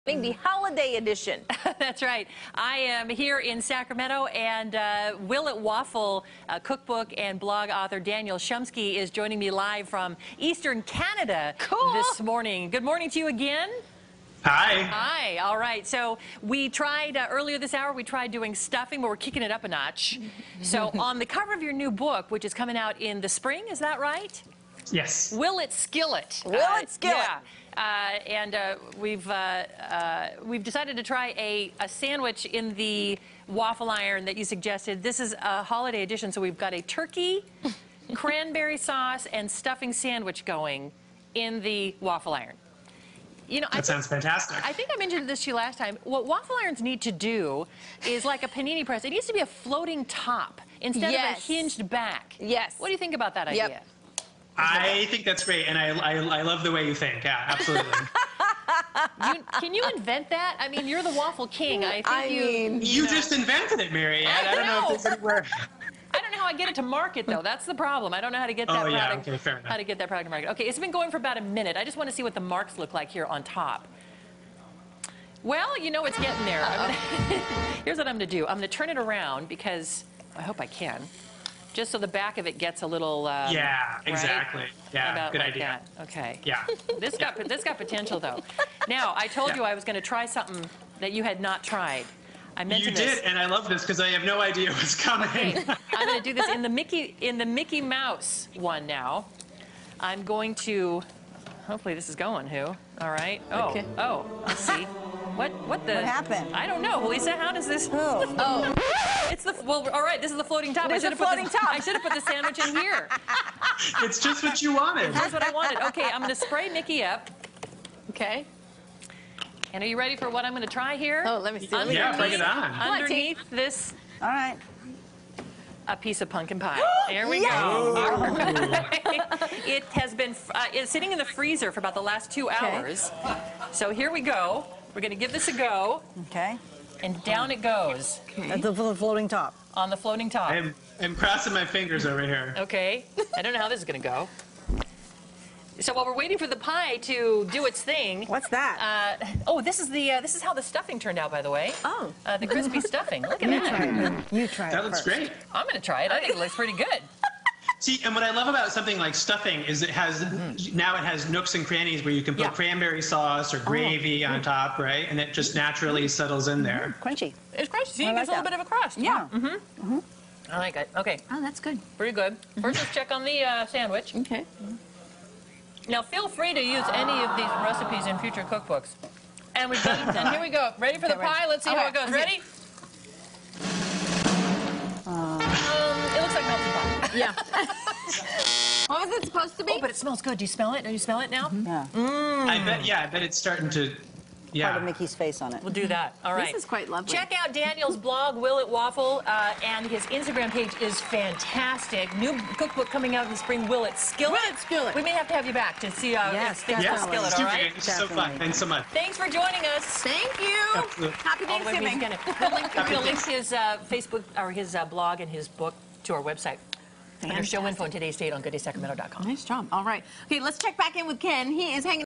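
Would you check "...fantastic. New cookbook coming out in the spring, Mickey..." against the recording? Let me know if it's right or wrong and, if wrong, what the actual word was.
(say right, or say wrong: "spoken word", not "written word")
wrong: "Will", not "Mickey".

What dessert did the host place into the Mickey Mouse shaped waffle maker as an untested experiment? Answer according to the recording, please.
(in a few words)
pumpkin pie.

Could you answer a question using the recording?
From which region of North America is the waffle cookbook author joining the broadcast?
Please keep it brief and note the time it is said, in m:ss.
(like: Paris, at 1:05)
Eastern Canada, at 0:10.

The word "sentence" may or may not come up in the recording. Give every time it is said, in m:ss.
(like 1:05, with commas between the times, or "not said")
not said.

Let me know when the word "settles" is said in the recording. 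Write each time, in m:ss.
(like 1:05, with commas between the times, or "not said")
2:46.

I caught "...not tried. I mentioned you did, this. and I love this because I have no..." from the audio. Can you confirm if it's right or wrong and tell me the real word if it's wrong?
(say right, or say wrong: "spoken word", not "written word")
right.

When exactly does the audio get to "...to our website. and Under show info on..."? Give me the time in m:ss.
3:36.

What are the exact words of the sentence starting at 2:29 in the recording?
Uh, oh, this is the uh, this is how the stuffing turned out, by the way.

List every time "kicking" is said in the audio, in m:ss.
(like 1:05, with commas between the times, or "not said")
0:19.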